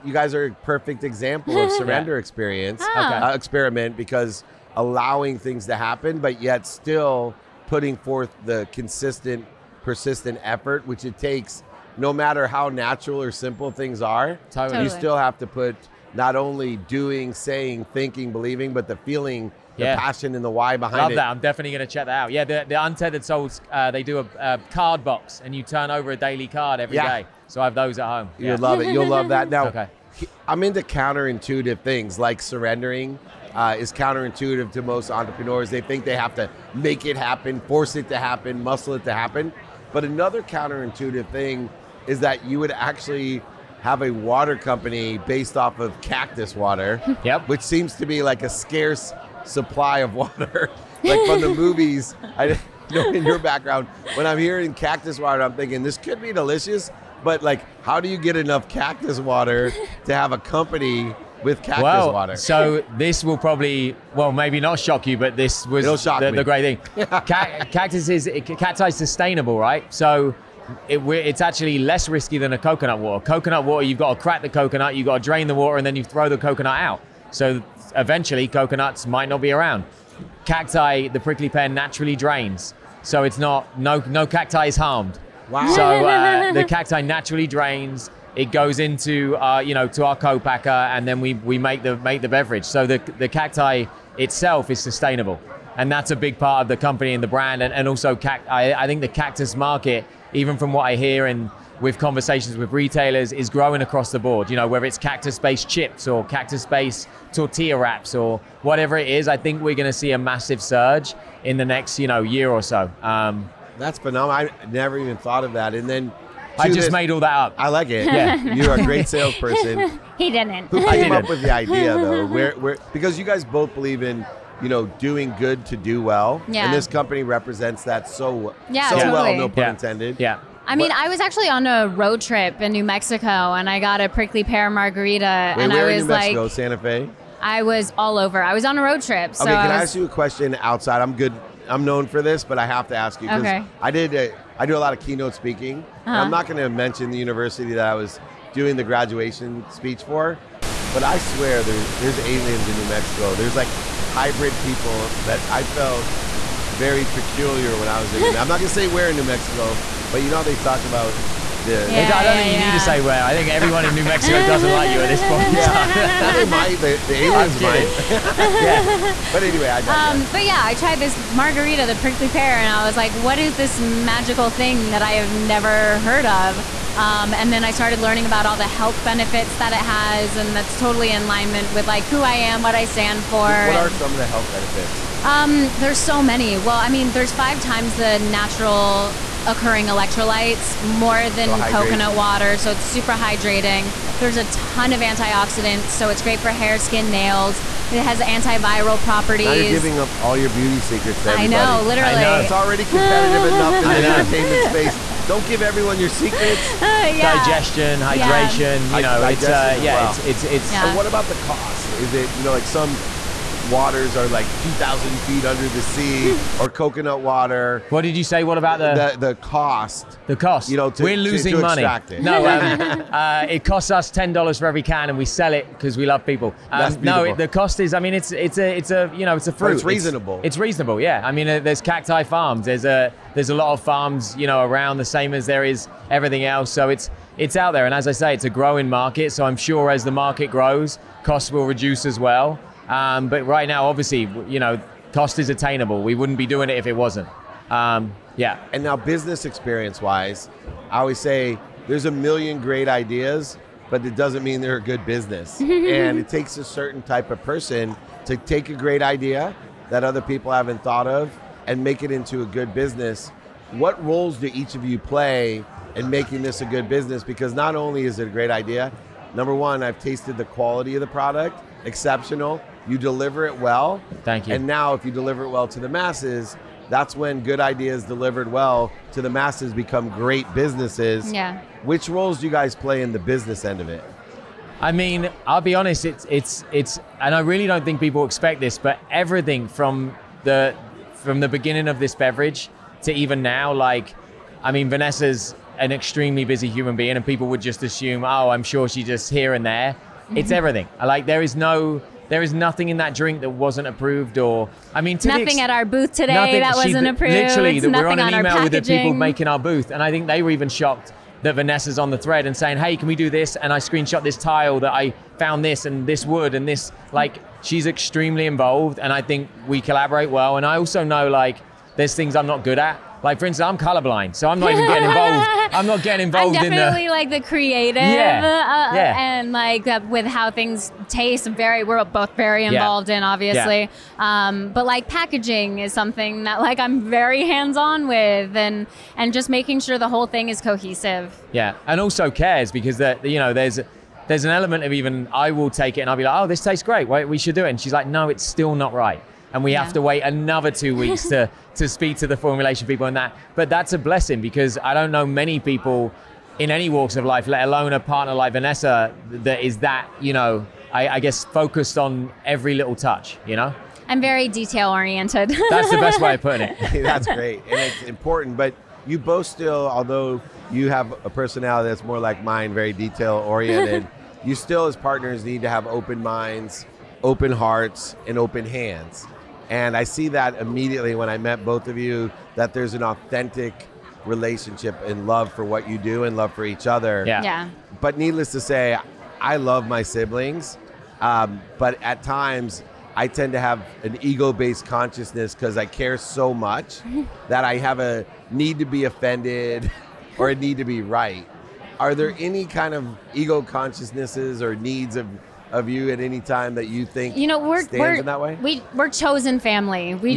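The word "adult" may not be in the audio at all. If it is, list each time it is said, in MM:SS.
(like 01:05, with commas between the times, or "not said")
not said.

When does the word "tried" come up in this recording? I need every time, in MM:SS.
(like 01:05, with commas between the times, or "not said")
02:50.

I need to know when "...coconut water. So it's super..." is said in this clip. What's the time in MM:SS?
03:11.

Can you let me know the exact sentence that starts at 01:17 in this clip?
So eventually, coconuts might not be around.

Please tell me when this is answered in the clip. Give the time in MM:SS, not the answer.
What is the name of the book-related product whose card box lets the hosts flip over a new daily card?
00:22.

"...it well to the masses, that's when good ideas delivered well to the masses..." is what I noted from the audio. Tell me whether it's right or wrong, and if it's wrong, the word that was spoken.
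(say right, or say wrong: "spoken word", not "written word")
right.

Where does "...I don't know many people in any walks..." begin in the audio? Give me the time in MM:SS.
05:54.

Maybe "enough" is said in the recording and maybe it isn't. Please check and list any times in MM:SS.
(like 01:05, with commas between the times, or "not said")
00:58, 03:23.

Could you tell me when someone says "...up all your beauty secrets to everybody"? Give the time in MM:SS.
03:19.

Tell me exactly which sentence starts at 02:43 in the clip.
I think everyone in New Mexico doesn't like you at this point.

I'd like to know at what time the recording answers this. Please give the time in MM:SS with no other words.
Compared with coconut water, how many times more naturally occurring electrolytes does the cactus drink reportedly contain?
03:07.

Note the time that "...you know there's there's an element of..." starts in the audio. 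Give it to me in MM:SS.
05:43.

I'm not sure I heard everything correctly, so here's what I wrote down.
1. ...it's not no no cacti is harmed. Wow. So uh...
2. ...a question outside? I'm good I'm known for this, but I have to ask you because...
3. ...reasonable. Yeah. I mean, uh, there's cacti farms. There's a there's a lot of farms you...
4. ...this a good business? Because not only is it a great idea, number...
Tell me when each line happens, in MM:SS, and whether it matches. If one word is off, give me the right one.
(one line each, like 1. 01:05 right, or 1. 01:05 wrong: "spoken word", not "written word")
1. 01:23 right
2. 02:20 right
3. 03:50 right
4. 04:26 right.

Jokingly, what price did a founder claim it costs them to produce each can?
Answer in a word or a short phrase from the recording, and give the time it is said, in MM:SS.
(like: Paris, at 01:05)
$10, at 03:44.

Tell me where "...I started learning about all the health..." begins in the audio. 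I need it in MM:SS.
02:57.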